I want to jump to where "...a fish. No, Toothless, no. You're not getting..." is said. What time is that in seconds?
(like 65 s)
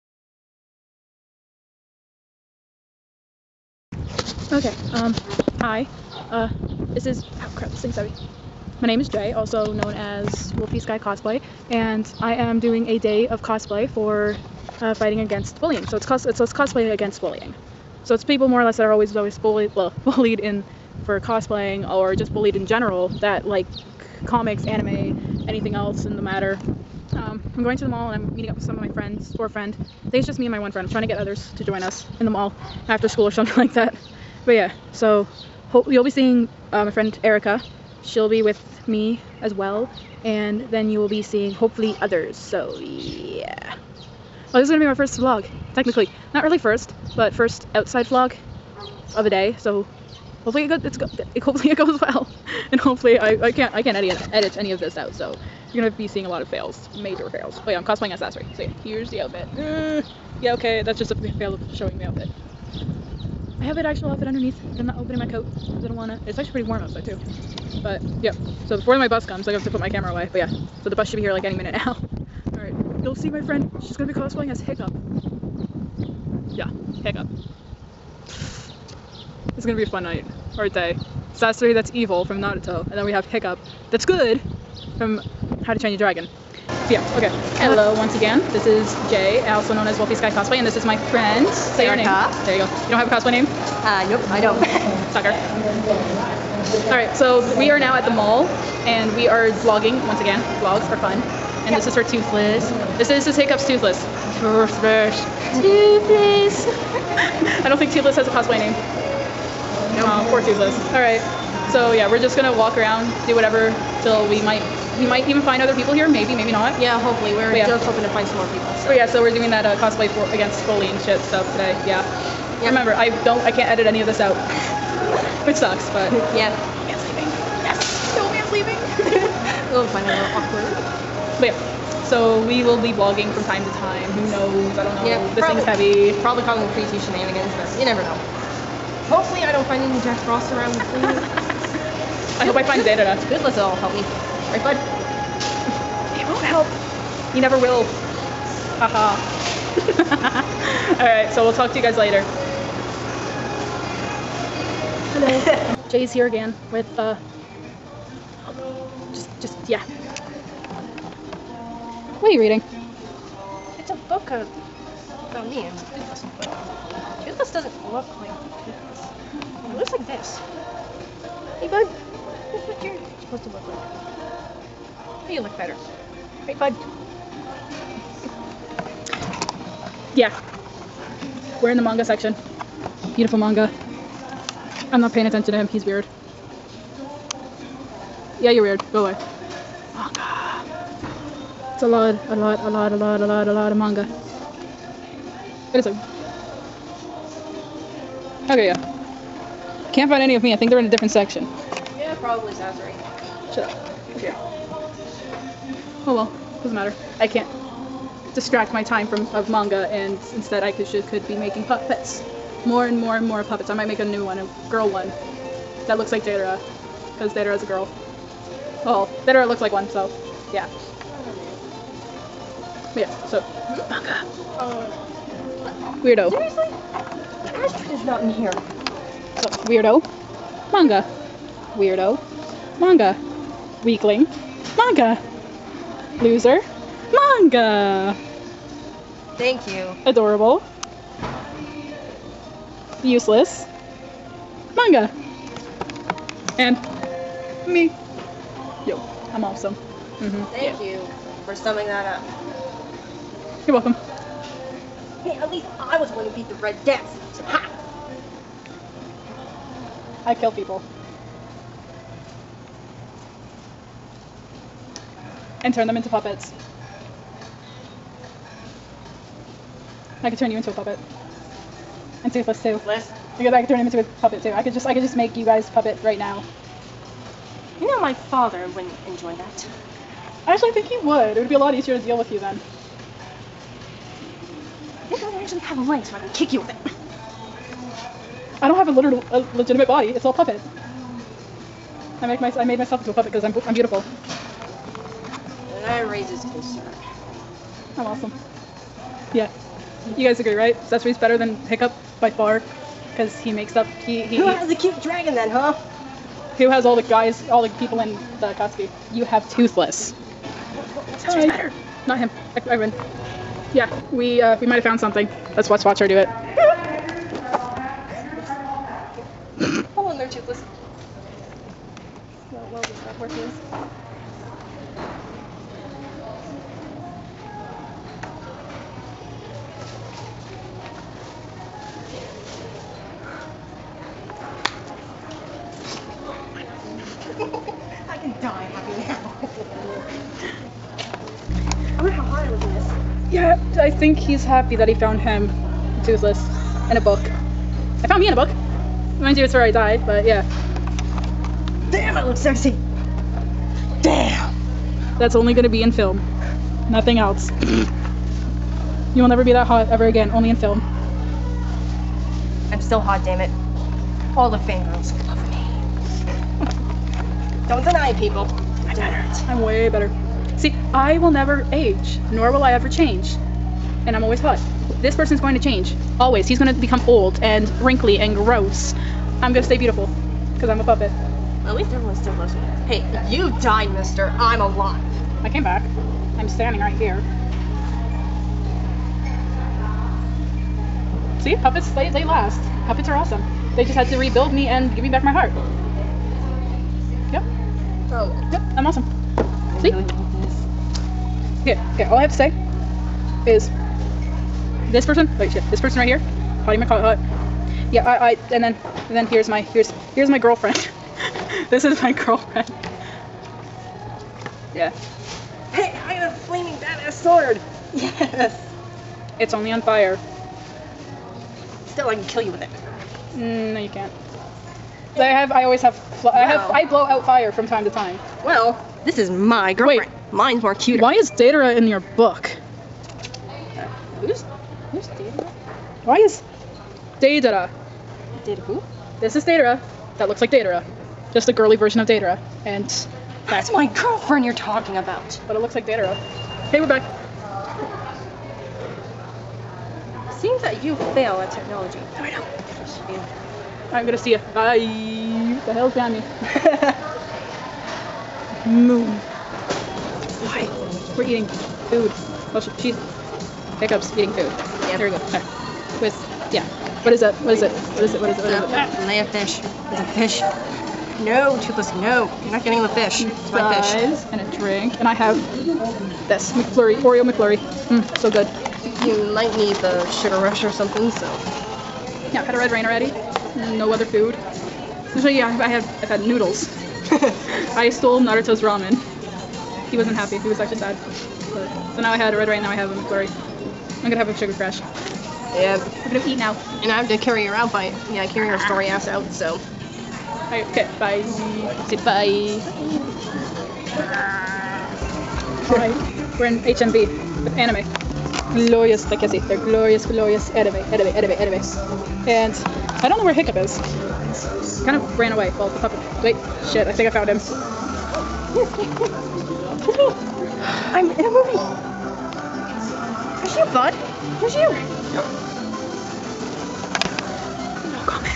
469 s.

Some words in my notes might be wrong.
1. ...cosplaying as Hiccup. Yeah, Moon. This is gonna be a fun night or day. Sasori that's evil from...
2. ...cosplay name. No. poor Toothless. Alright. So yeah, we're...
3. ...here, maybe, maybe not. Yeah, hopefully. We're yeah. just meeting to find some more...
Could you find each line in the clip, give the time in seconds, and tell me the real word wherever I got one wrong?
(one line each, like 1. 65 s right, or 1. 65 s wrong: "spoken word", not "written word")
1. 74 s wrong: "Hiccup", not "Moon"
2. 108 s right
3. 115 s wrong: "hoping", not "meeting".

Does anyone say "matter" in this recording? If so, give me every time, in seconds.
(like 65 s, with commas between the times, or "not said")
26 s, 206 s.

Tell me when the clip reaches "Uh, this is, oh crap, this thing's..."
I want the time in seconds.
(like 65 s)
6 s.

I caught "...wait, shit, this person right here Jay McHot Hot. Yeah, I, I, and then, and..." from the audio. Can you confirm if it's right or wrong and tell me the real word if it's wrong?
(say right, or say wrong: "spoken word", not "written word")
wrong: "Potty", not "Jay".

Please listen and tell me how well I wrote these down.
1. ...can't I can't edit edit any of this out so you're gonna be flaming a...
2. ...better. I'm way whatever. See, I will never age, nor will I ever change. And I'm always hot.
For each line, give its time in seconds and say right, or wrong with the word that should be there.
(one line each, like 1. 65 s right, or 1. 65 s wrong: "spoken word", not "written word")
1. 53 s wrong: "seeing", not "flaming"
2. 368 s wrong: "better", not "whatever".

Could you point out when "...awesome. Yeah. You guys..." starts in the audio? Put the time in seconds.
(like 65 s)
298 s.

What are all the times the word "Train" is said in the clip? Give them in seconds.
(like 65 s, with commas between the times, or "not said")
85 s.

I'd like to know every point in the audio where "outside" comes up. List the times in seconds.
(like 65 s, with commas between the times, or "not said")
47 s, 66 s.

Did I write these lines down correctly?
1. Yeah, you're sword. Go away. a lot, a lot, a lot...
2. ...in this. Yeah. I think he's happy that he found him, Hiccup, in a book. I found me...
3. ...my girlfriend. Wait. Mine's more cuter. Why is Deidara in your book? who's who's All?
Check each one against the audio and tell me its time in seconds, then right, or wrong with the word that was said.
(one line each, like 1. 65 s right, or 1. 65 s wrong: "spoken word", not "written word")
1. 188 s wrong: "weird", not "sword"
2. 342 s wrong: "Toothless", not "Hiccup"
3. 429 s wrong: "Deidara", not "All".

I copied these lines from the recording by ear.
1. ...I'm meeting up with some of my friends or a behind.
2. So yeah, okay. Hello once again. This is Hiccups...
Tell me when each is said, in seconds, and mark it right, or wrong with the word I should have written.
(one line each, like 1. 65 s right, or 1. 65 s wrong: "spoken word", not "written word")
1. 28 s wrong: "friend", not "behind"
2. 86 s wrong: "Jay", not "Hiccups".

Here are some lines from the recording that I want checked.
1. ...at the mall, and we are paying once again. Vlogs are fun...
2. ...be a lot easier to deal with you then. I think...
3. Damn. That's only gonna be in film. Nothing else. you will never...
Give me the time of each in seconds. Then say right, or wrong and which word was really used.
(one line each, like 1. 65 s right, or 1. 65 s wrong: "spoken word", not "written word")
1. 97 s wrong: "vlogging", not "paying"
2. 281 s right
3. 354 s right.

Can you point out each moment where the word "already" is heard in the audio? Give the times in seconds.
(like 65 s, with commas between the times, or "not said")
482 s.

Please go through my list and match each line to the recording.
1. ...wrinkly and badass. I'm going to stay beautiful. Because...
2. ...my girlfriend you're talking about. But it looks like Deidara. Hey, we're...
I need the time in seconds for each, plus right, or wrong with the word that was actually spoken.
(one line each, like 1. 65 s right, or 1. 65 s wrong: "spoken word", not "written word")
1. 377 s wrong: "gross", not "badass"
2. 443 s right.